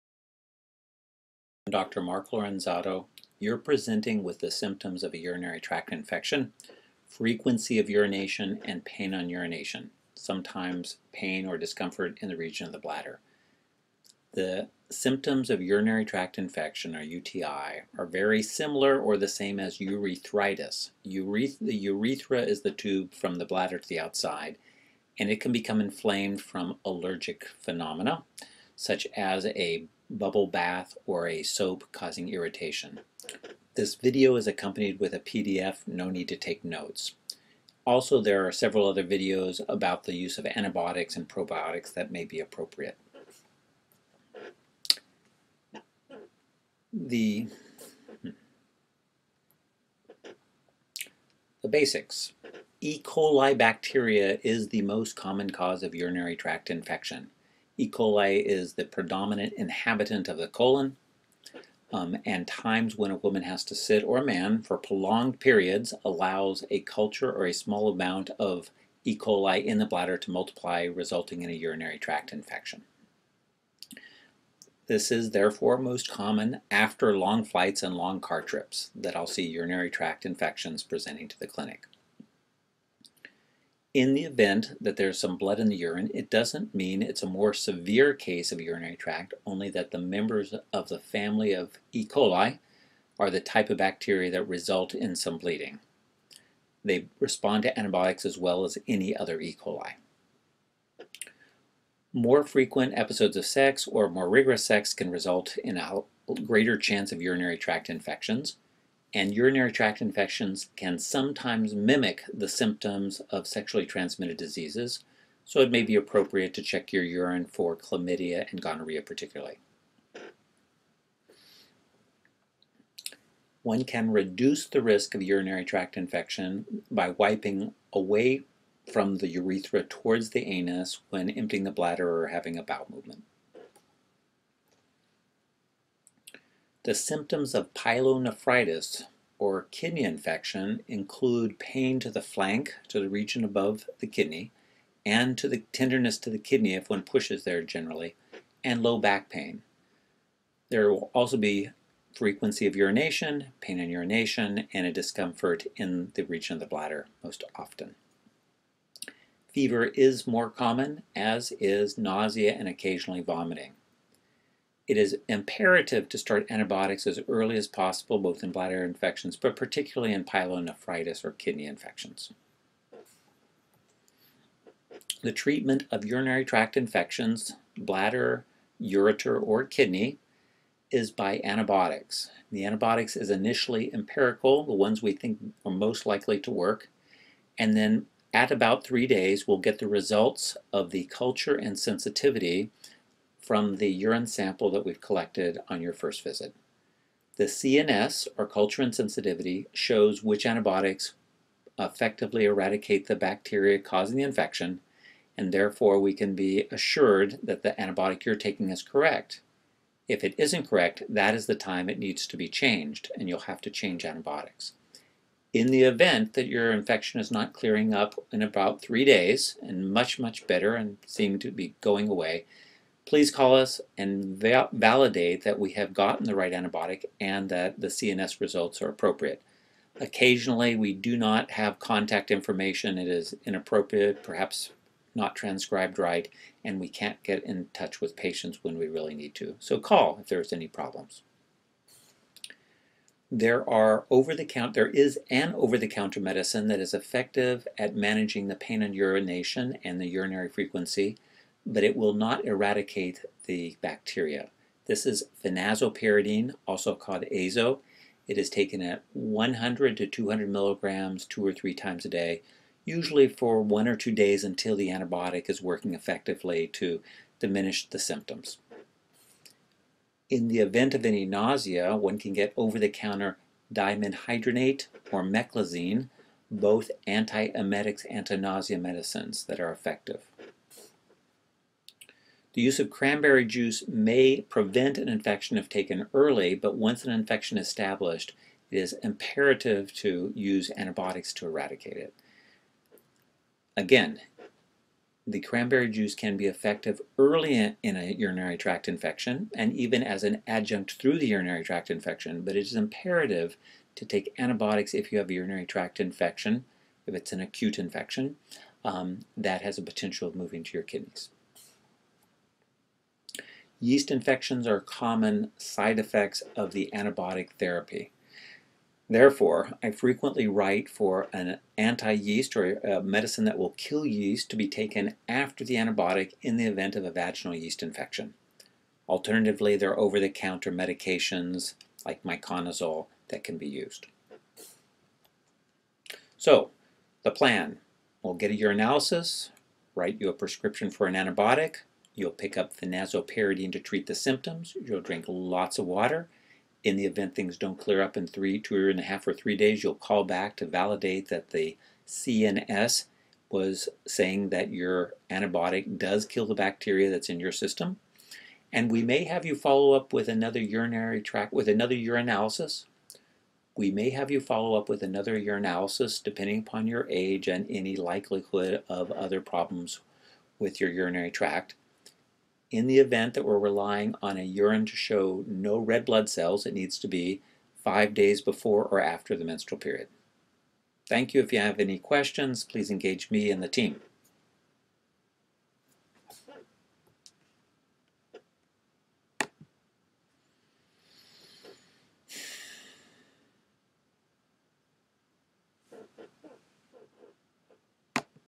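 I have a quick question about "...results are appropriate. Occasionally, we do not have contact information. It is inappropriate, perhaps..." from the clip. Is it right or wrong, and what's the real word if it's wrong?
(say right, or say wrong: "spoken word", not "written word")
right.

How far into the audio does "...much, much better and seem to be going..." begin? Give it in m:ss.
3:39.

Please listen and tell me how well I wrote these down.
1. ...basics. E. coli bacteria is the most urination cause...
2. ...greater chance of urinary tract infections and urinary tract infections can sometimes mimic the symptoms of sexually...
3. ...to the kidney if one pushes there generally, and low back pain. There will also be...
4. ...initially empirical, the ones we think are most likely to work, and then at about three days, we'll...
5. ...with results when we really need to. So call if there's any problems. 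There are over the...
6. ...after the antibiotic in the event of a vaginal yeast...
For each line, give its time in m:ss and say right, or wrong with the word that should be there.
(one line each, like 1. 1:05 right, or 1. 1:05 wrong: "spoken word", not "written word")
1. 0:51 wrong: "common", not "urination"
2. 1:46 right
3. 2:26 right
4. 3:03 right
5. 3:57 wrong: "patients", not "results"
6. 5:25 right.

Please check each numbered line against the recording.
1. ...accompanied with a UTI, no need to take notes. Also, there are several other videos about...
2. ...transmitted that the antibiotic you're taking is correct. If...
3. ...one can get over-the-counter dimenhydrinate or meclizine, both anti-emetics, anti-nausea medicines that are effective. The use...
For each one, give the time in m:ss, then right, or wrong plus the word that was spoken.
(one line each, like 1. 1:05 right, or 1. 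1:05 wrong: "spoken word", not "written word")
1. 0:34 wrong: "PDF", not "UTI"
2. 3:26 wrong: "assured", not "transmitted"
3. 4:31 right.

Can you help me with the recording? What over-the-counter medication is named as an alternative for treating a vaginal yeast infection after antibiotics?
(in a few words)
miconazole.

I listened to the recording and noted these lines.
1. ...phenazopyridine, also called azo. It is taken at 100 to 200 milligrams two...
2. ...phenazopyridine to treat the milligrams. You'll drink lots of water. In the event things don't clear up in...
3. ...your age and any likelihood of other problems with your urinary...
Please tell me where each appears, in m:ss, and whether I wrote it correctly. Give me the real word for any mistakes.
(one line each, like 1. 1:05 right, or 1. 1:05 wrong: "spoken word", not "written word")
1. 4:15 right
2. 5:42 wrong: "symptoms", not "milligrams"
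3. 6:06 right.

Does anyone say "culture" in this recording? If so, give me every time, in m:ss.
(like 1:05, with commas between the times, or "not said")
1:06, 3:11, 3:18.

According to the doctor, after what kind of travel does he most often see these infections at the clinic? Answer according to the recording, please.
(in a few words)
long flights.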